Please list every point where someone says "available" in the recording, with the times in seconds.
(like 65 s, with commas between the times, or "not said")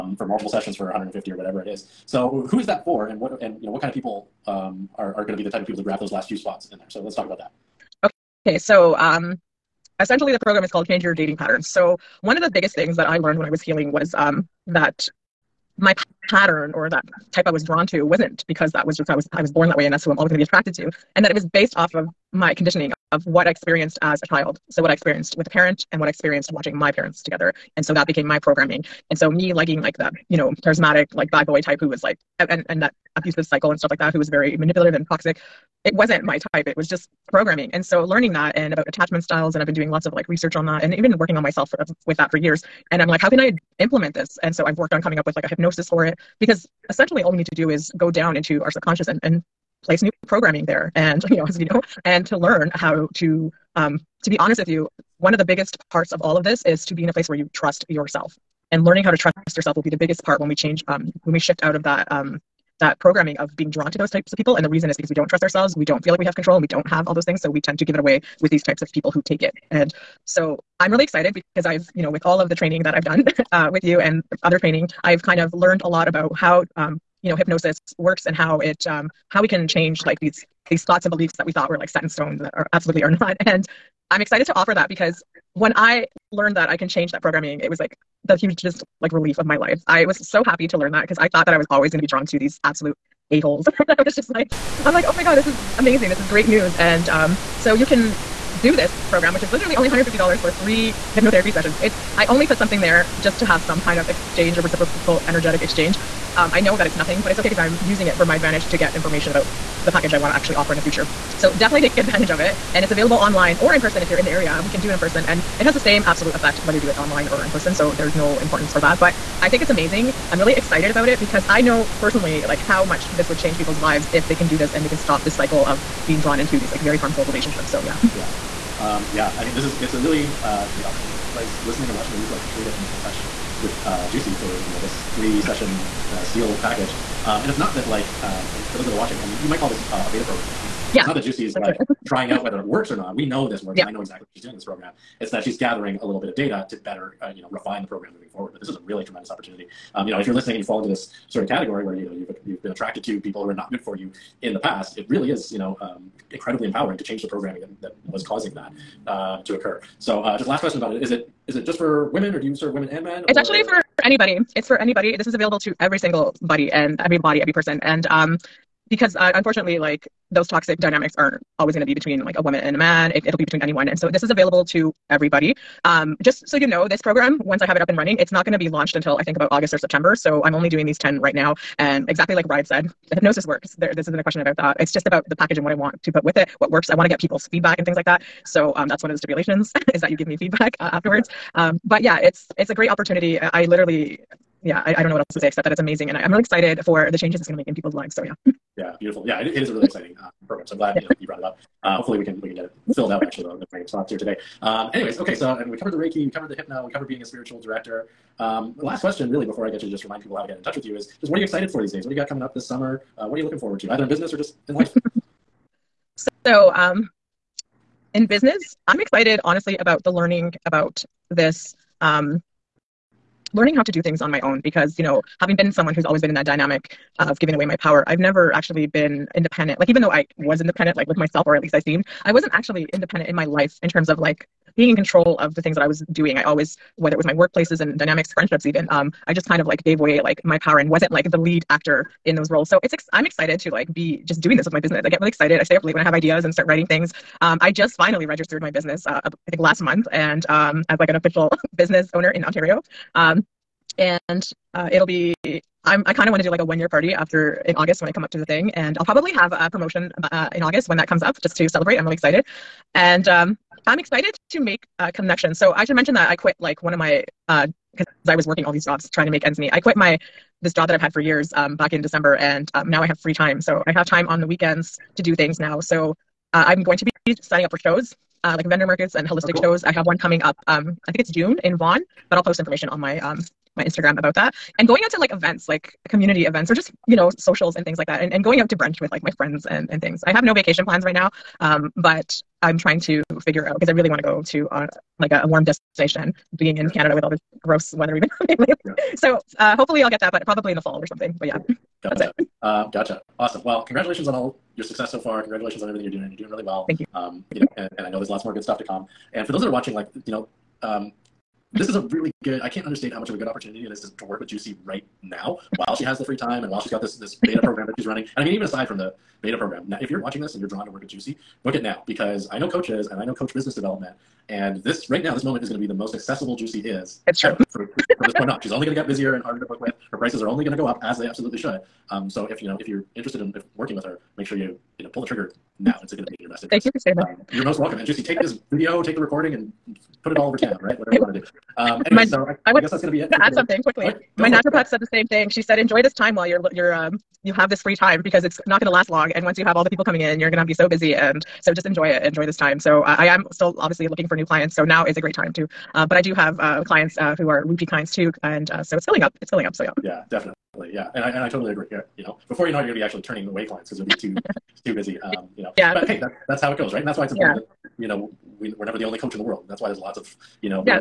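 112 s, 165 s, 174 s.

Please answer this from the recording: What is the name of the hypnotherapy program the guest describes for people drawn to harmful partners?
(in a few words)
Change Your Dating Patterns.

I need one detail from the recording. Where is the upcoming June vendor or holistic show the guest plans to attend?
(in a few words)
Vaughan.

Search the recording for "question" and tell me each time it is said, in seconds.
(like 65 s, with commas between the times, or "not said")
160 s, 184 s, 209 s.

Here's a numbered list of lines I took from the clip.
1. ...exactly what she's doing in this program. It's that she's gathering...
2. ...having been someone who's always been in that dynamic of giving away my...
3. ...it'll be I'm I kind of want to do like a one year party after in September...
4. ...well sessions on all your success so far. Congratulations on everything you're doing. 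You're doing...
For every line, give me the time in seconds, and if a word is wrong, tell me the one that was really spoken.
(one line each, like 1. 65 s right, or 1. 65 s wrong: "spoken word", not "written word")
1. 144 s right
2. 225 s right
3. 254 s wrong: "August", not "September"
4. 303 s wrong: "congratulations", not "sessions".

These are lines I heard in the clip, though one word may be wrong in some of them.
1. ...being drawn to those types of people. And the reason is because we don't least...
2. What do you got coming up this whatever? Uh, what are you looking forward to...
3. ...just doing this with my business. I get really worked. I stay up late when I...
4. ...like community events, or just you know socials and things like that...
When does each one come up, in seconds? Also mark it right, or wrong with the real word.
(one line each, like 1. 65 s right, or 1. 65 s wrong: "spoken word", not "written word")
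1. 63 s wrong: "trust", not "least"
2. 212 s wrong: "summer", not "whatever"
3. 244 s wrong: "excited", not "worked"
4. 285 s right.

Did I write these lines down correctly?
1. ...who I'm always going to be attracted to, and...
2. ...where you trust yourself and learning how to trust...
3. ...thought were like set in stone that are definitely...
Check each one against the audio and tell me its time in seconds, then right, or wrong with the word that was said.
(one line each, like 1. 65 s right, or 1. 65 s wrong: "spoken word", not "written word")
1. 20 s right
2. 57 s right
3. 81 s wrong: "absolutely", not "definitely".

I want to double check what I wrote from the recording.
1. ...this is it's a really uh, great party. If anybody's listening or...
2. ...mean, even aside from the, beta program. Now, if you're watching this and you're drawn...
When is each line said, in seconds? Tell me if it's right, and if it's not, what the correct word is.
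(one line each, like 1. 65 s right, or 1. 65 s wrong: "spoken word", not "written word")
1. 129 s wrong: "opportunity", not "party"
2. 318 s right.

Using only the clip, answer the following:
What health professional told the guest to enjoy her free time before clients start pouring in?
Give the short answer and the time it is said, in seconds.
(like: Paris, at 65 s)
Naturopath, at 344 s.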